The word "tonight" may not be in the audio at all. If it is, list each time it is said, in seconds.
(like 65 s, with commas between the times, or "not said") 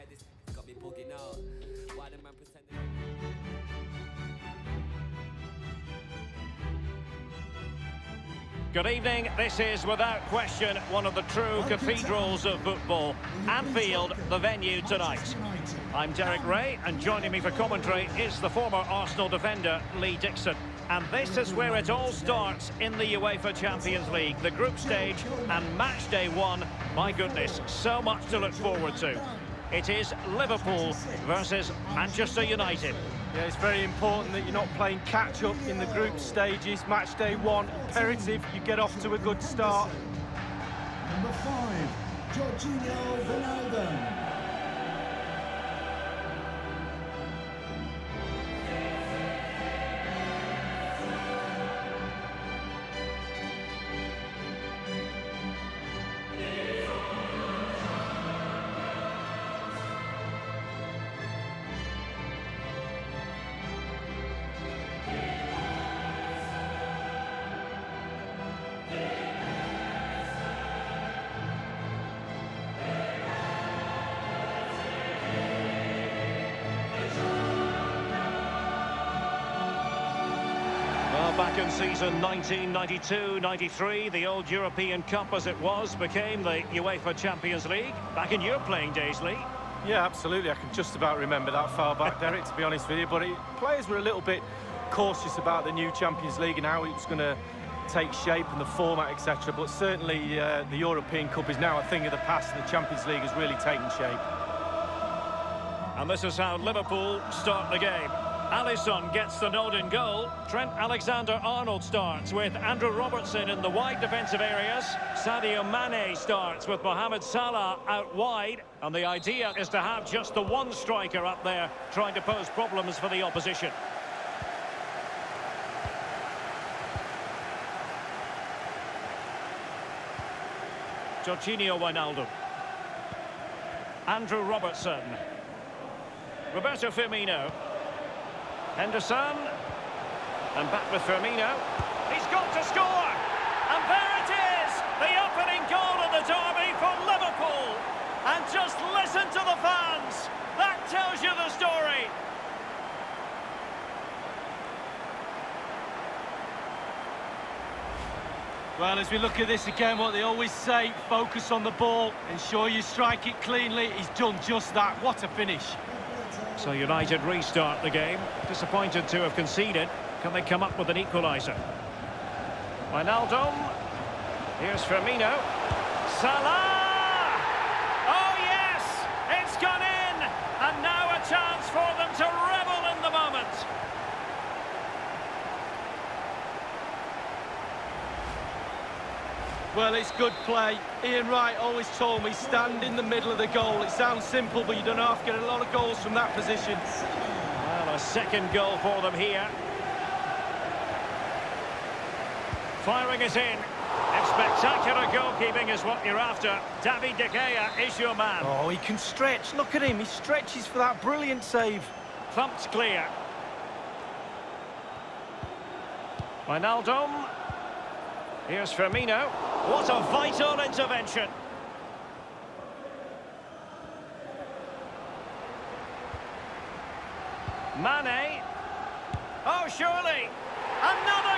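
14 s.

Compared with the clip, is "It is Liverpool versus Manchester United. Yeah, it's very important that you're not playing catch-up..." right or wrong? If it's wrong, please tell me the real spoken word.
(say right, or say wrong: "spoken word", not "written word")
right.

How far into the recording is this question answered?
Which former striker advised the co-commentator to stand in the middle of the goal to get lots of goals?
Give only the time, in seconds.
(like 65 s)
191 s.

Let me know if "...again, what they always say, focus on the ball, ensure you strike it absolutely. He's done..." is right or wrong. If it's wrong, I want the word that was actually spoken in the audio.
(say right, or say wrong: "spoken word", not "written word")
wrong: "cleanly", not "absolutely".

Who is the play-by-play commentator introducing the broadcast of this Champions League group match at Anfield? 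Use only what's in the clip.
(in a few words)
Derek Ray.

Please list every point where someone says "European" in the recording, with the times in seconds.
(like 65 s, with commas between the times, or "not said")
84 s, 100 s.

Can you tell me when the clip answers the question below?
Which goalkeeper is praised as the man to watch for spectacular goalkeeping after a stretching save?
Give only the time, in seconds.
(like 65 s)
206 s.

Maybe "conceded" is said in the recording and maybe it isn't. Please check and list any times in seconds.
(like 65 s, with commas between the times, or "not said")
169 s.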